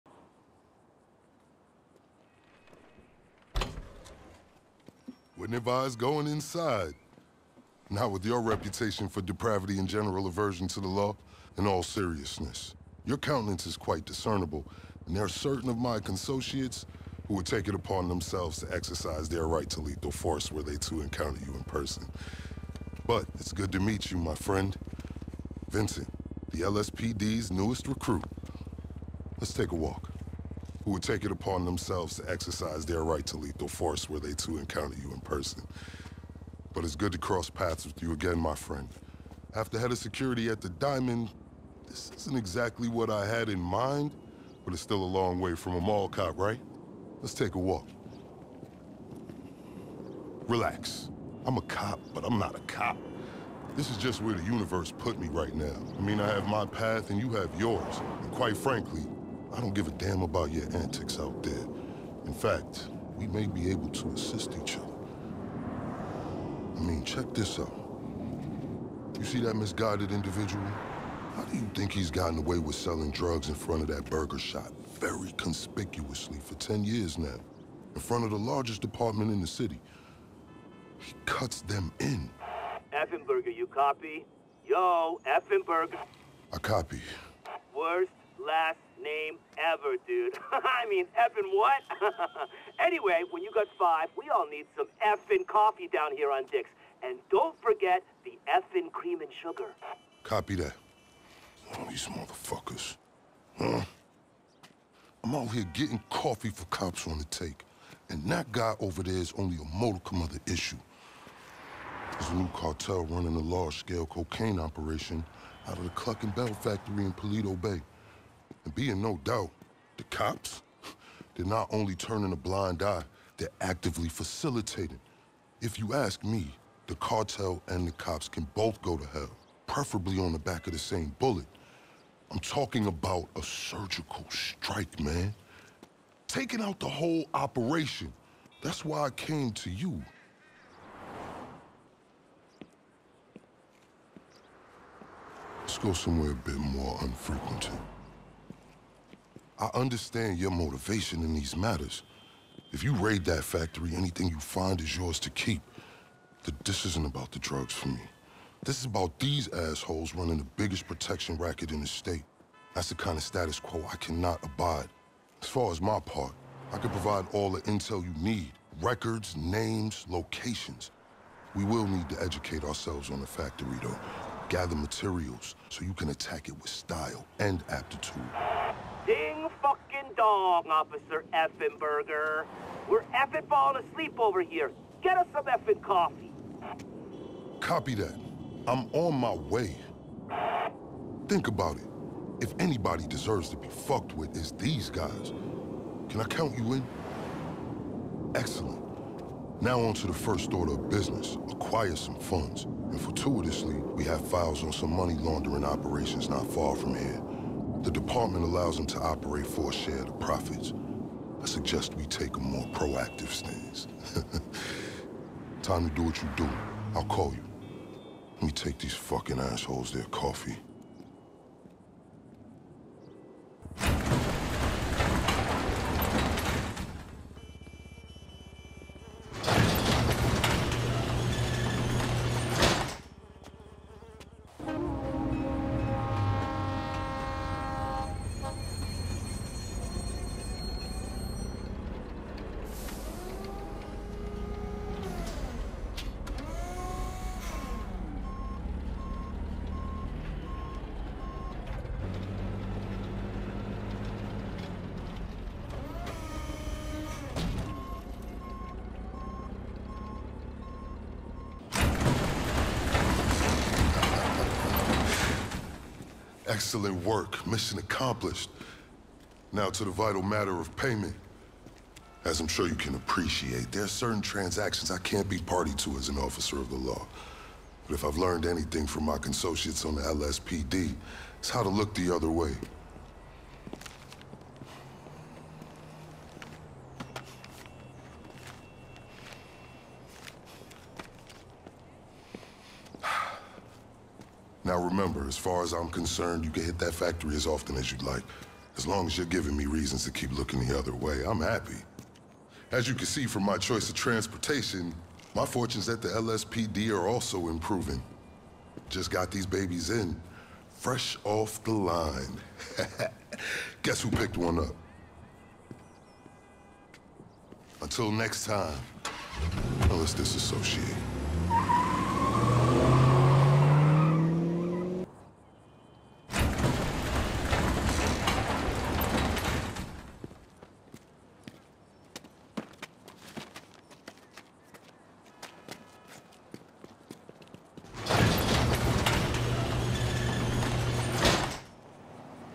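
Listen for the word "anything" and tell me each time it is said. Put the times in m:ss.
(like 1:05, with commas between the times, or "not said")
2:33, 4:38.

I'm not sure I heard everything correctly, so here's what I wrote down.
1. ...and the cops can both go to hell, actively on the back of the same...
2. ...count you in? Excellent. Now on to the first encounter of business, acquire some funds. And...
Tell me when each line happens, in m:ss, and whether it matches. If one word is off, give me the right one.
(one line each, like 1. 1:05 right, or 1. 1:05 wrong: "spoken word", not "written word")
1. 2:07 wrong: "preferably", not "actively"
2. 3:16 wrong: "order", not "encounter".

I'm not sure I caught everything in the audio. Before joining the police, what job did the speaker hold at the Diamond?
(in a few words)
Head of security.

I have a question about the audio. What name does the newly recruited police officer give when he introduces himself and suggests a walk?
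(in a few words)
Vincent.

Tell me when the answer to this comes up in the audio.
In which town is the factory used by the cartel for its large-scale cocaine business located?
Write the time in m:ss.
1:57.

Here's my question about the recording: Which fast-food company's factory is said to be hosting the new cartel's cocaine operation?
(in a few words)
Cluckin' Bell.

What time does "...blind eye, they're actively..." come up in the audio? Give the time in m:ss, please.
2:02.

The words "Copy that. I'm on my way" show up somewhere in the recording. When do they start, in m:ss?
3:07.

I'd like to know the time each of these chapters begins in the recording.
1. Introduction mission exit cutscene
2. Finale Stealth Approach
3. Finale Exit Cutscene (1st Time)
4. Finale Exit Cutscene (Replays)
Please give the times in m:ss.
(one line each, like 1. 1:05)
1. 3:43
2. 3:54
3. 4:22
4. 5:25.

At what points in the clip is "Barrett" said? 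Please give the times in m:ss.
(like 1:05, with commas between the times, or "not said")
not said.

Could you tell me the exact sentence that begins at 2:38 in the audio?
This is about these assholes running the biggest protection racket in the state.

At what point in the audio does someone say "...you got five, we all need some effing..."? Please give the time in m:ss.
1:33.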